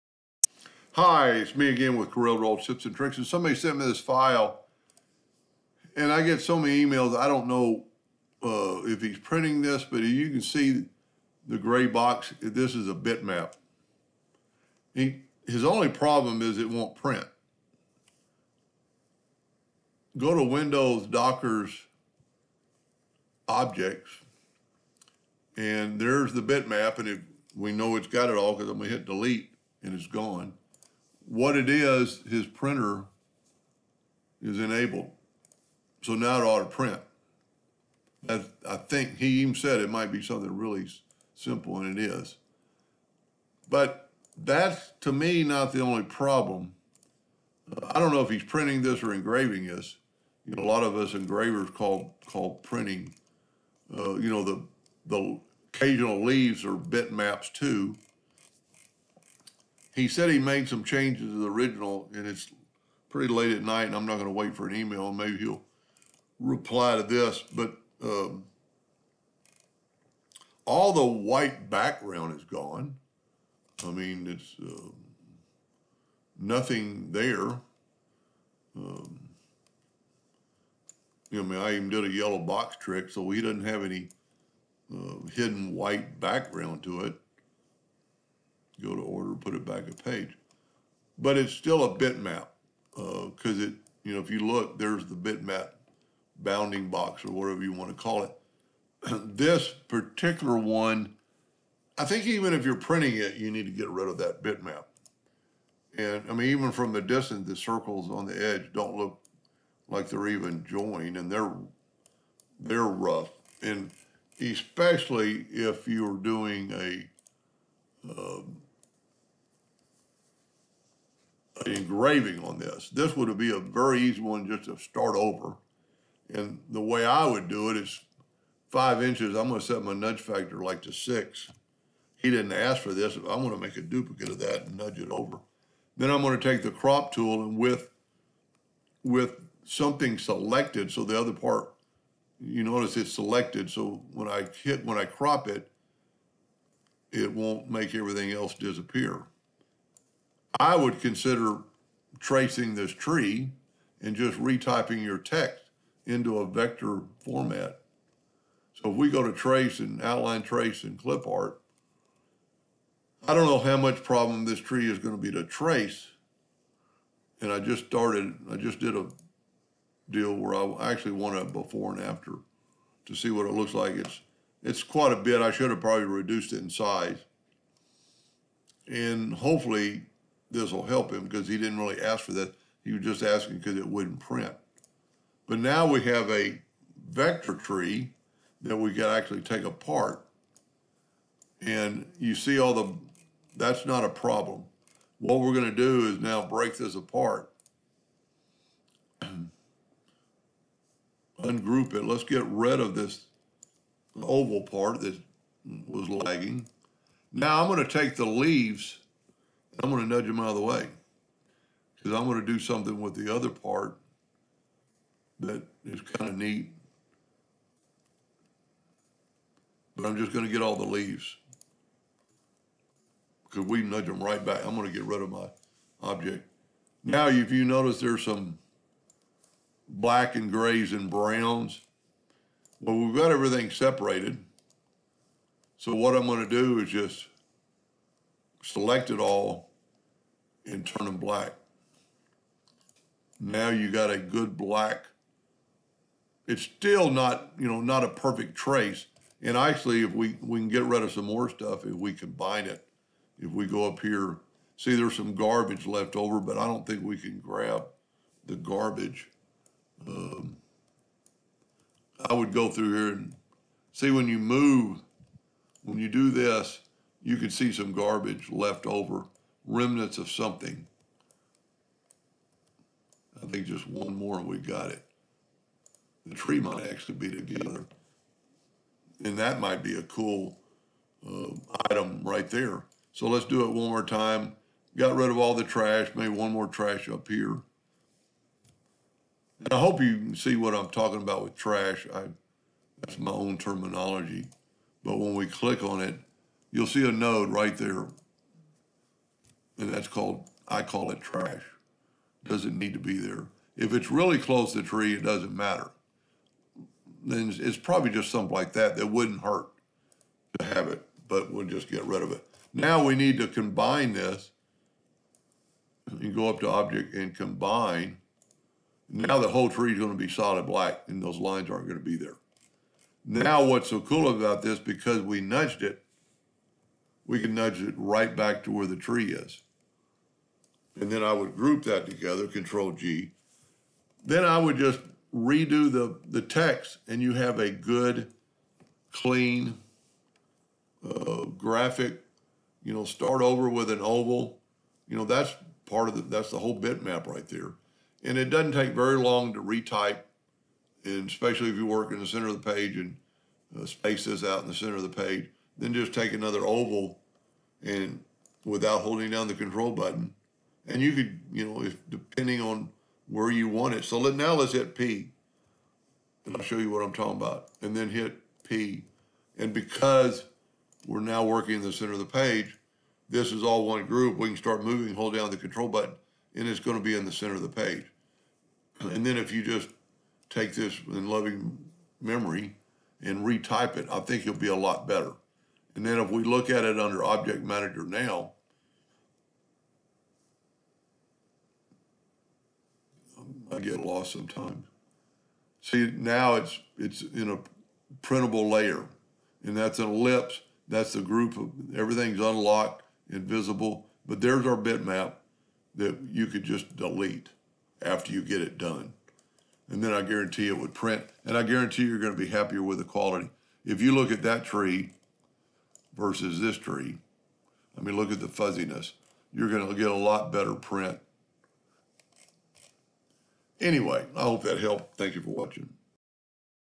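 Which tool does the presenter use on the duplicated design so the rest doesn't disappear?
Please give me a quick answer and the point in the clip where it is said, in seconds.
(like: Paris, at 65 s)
Crop tool, at 136 s.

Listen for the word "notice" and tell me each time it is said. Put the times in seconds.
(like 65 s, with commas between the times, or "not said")
142 s, 227 s.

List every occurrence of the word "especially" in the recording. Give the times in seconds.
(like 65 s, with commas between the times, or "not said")
114 s, 351 s.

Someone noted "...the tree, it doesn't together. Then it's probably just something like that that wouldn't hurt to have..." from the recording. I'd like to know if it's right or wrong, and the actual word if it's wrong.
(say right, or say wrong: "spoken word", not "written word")
wrong: "matter", not "together".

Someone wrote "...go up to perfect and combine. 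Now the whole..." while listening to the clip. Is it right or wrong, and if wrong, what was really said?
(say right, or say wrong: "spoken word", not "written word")
wrong: "object", not "perfect".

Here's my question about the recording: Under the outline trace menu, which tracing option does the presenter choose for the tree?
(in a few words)
Clip art.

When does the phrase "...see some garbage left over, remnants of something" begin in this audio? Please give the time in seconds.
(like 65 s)
267 s.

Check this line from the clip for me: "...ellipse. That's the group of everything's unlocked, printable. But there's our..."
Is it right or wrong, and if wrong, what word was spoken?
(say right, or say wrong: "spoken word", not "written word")
wrong: "invisible", not "printable".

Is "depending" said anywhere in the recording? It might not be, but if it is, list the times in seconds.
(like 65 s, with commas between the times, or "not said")
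362 s.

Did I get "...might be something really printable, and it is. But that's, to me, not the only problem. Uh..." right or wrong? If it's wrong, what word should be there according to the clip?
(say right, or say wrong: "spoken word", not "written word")
wrong: "simple", not "printable".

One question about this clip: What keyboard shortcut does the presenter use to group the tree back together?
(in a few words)
Control G.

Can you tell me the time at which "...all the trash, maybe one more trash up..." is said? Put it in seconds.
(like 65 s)
285 s.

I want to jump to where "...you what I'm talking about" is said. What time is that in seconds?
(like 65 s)
366 s.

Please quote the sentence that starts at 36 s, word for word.
So now it ought to print.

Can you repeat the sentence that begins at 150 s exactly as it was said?
I would consider tracing this tree and just retyping your text into a vector format.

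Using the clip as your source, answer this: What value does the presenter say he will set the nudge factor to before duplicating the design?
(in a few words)
6.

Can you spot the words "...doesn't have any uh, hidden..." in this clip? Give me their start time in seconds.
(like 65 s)
83 s.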